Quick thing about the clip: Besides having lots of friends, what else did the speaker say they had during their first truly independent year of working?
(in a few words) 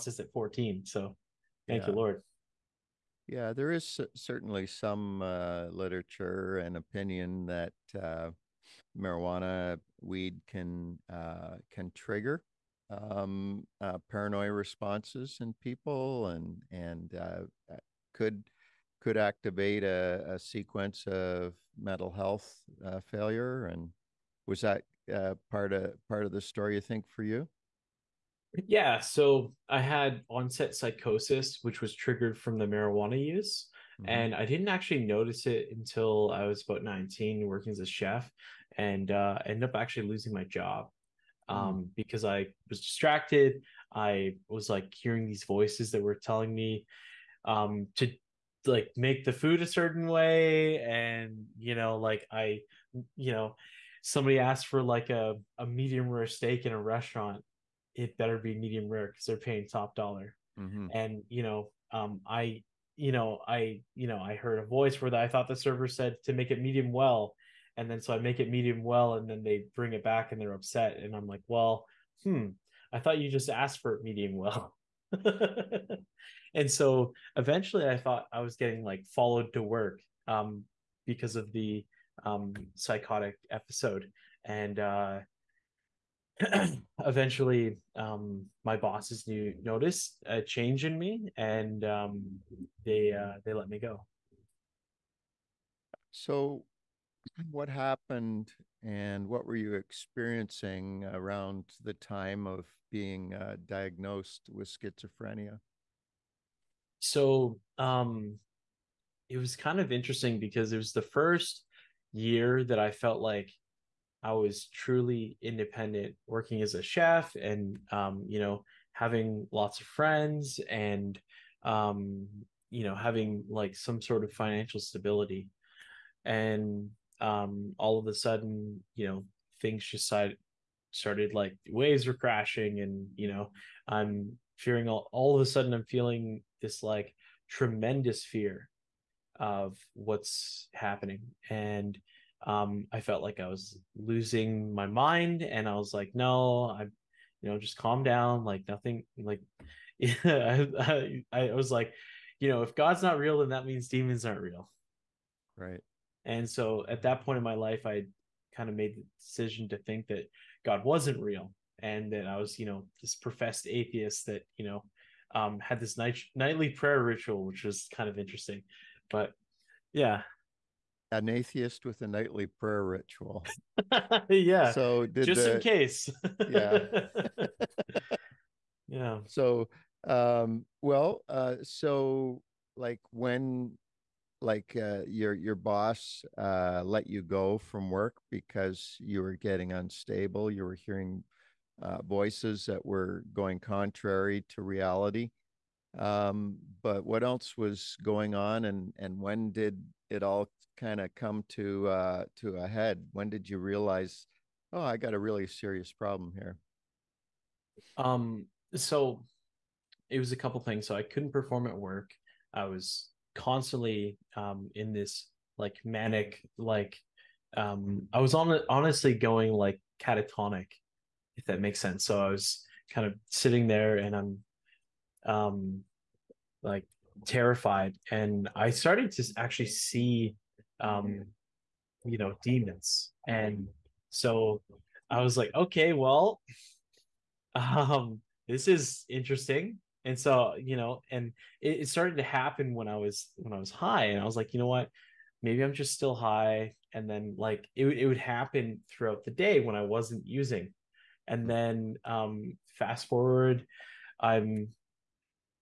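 financial stability.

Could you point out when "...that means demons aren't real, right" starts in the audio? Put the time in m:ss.
2:33.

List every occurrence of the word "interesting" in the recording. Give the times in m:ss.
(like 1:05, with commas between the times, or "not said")
1:49, 2:48, 3:59.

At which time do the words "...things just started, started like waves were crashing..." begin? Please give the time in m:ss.
2:09.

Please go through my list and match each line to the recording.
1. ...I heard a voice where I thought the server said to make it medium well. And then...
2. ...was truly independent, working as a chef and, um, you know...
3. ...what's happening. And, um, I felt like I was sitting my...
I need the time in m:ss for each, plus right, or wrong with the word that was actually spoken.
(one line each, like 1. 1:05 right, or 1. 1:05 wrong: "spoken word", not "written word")
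1. 1:04 right
2. 1:54 right
3. 2:19 wrong: "losing", not "sitting".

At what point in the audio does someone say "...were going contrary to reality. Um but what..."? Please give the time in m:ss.
3:12.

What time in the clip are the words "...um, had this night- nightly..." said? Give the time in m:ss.
2:45.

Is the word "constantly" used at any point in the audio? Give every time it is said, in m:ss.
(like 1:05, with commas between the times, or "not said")
3:33.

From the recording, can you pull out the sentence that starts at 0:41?
um, mm because I was distracted.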